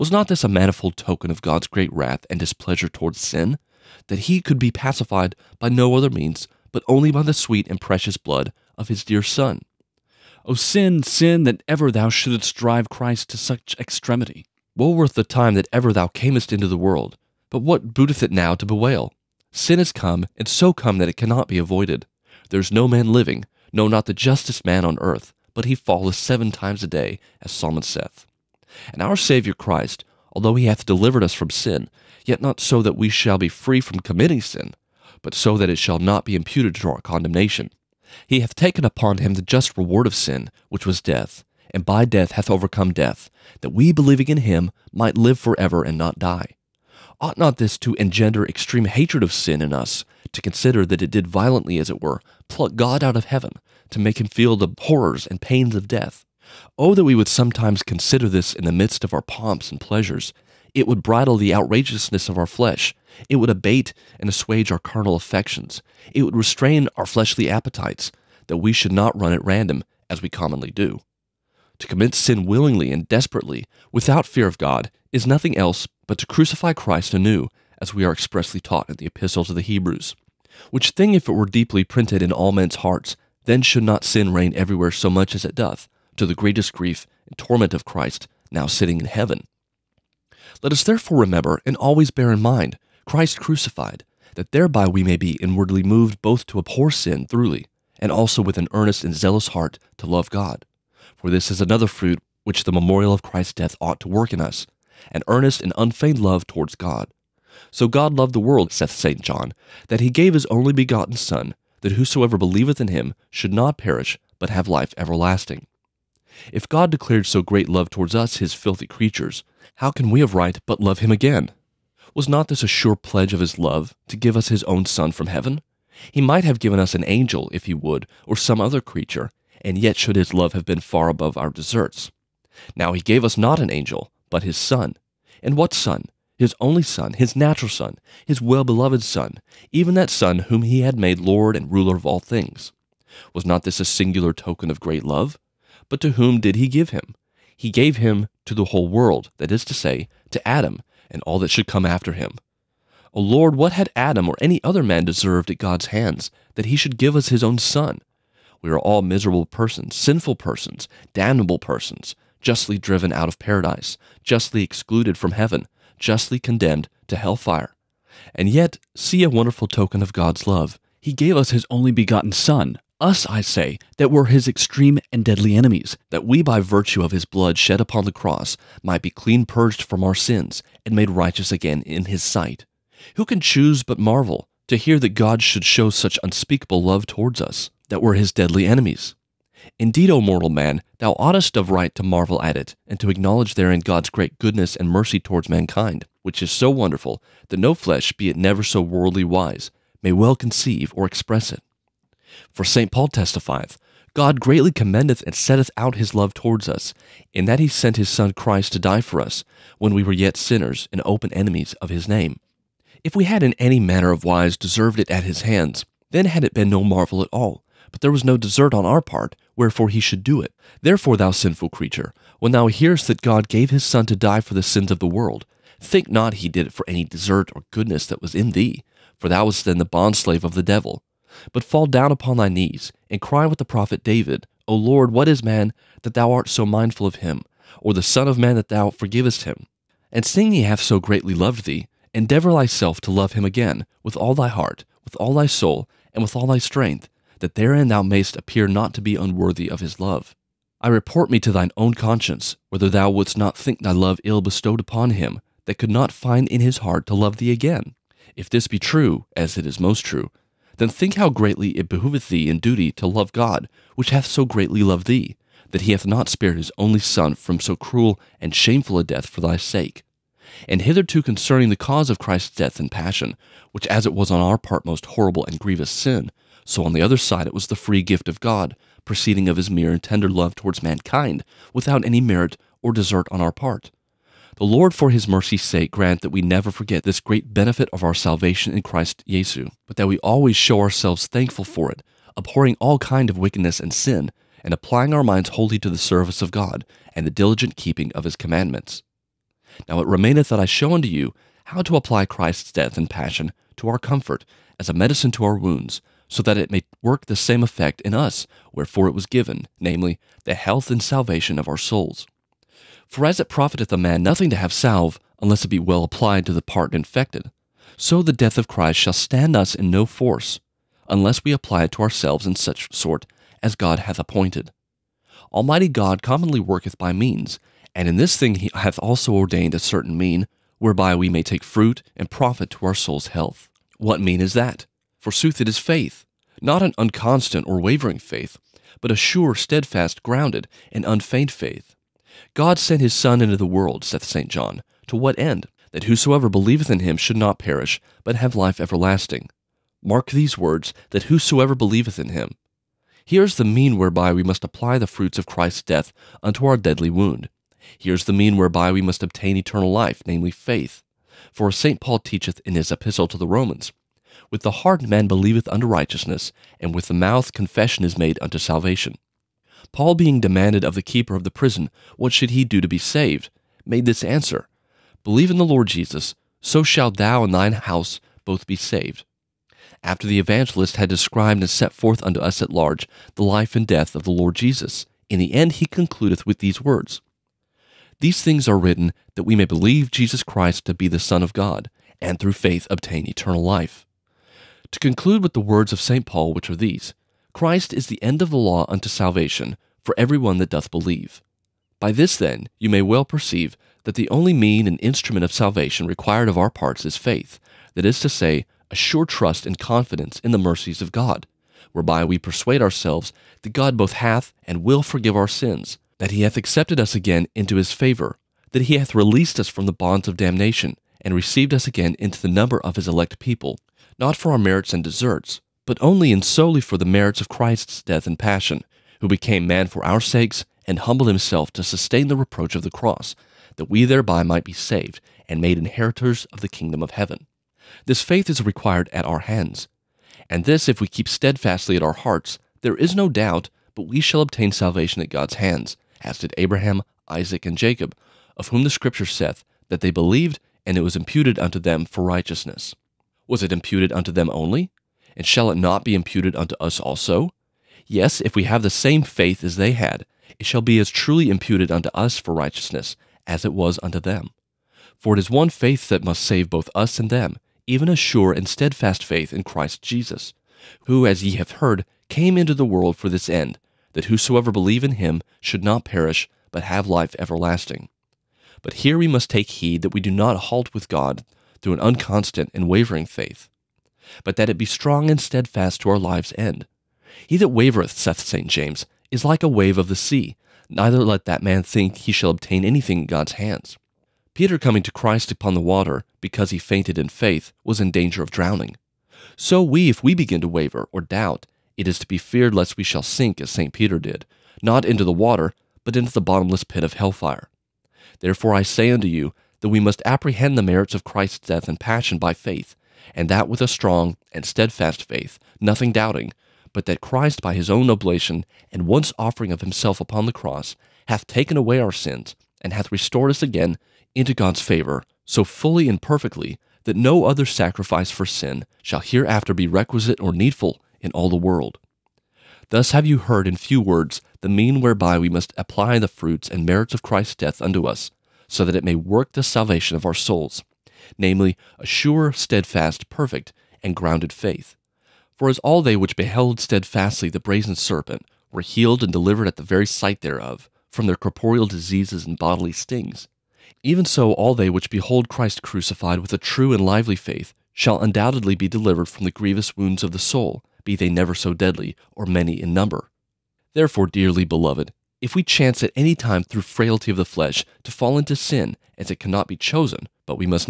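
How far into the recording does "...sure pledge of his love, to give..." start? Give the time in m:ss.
2:02.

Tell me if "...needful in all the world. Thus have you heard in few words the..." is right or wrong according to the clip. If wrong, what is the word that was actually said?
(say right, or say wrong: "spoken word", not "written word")
right.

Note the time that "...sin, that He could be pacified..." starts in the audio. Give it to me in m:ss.
0:03.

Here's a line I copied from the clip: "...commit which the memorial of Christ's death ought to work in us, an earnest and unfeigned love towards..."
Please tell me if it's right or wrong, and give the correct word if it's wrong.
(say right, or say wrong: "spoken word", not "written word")
wrong: "fruit", not "commit".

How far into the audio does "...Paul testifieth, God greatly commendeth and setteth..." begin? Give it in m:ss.
3:22.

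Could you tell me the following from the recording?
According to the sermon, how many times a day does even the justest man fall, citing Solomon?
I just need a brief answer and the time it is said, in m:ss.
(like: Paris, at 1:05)
7, at 0:26.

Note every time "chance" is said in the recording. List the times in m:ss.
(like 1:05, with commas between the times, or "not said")
9:25.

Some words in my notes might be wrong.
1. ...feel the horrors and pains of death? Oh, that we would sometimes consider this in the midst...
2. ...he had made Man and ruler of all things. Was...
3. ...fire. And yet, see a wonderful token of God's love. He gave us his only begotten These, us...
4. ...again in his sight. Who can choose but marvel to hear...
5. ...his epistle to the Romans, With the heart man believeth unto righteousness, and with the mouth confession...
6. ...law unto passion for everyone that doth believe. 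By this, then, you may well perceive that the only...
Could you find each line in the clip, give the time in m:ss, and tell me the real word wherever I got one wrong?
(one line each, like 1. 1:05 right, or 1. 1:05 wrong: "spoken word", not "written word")
1. 0:54 right
2. 2:20 wrong: "Lord", not "Man"
3. 2:47 wrong: "Son", not "These"
4. 3:01 right
5. 6:02 right
6. 6:38 wrong: "salvation", not "passion".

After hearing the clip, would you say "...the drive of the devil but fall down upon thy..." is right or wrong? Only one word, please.
wrong.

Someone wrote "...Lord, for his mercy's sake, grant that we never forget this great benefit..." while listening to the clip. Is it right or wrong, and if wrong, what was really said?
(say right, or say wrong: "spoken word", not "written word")
right.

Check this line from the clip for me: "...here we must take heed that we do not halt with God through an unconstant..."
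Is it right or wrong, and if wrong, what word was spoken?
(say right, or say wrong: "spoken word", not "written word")
right.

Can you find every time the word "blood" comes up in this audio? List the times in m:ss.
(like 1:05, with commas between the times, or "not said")
0:08, 2:57.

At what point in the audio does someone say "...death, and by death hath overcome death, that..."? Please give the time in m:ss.
0:41.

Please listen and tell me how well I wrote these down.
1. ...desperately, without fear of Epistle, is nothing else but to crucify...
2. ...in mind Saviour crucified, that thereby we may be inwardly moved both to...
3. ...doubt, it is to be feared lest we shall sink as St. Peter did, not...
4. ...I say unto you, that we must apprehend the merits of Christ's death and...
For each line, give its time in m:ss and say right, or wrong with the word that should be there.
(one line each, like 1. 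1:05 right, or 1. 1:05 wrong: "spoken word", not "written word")
1. 1:13 wrong: "God", not "Epistle"
2. 1:32 wrong: "Christ", not "Saviour"
3. 8:21 right
4. 8:28 right.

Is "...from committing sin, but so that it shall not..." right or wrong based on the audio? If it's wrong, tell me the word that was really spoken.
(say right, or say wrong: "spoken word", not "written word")
right.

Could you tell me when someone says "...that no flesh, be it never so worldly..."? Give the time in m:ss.
3:17.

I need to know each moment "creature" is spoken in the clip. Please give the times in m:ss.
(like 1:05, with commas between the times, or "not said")
1:58, 2:08, 3:41.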